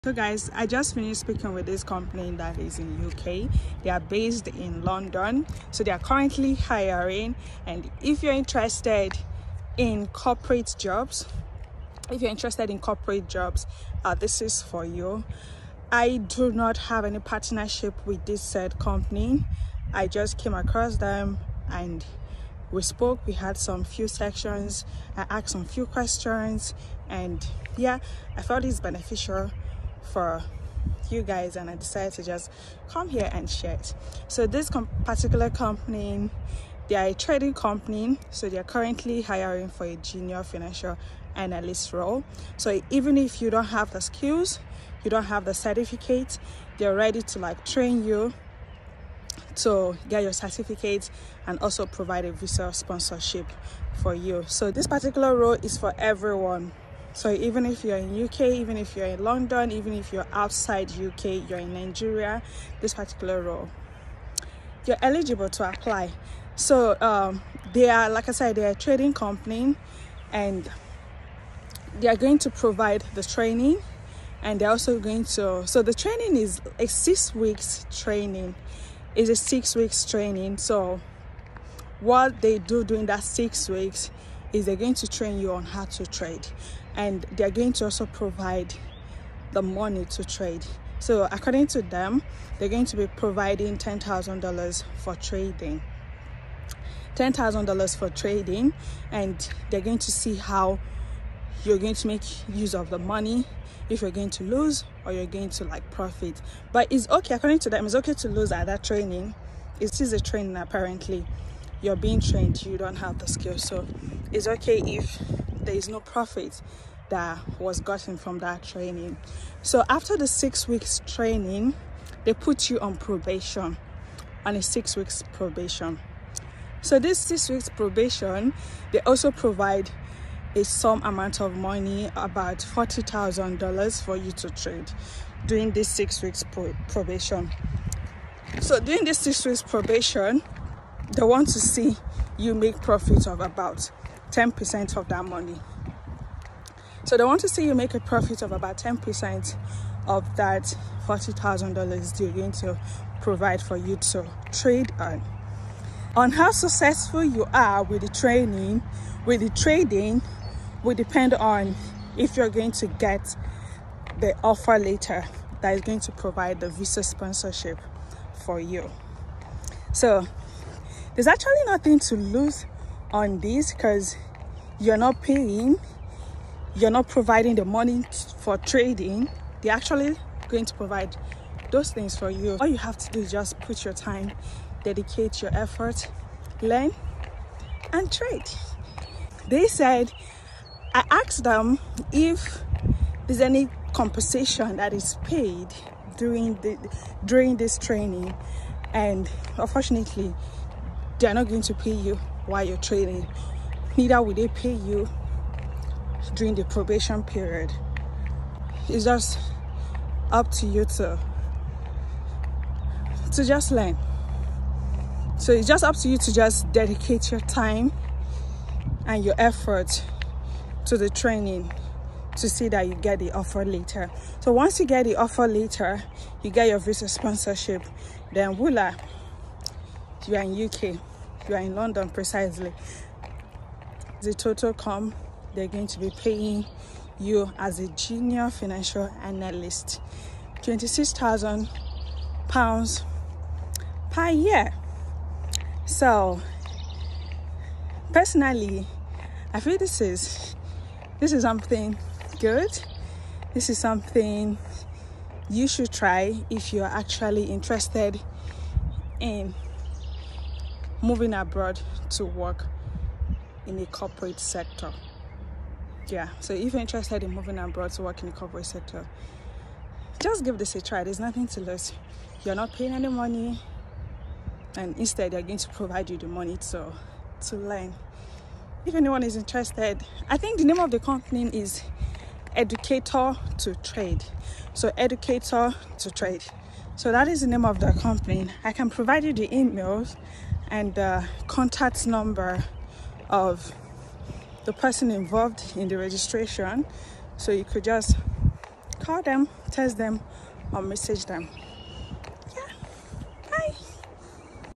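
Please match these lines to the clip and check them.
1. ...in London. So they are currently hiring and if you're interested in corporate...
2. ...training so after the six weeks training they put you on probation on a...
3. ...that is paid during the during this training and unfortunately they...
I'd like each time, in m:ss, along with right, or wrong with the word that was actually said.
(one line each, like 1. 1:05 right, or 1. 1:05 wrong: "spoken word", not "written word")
1. 0:04 right
2. 1:58 right
3. 3:14 right.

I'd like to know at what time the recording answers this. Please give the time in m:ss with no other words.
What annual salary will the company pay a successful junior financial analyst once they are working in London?
4:00.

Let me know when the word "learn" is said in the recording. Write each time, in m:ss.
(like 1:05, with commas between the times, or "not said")
3:06, 3:33, 4:37.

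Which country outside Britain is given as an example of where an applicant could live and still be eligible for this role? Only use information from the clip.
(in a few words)
Nigeria.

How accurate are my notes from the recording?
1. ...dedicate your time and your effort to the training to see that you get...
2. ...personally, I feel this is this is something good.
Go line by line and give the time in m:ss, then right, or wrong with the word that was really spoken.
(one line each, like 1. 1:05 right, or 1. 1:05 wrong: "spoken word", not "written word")
1. 3:36 right
2. 4:08 right.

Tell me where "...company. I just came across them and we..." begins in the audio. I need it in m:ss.
0:18.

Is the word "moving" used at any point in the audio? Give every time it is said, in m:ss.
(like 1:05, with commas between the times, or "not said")
4:21, 4:27.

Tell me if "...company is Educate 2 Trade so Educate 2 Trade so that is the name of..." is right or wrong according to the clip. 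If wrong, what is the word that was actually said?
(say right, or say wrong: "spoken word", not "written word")
right.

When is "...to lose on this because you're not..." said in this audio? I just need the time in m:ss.
2:51.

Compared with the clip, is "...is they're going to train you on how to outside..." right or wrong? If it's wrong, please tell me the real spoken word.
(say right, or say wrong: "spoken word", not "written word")
wrong: "trade", not "outside".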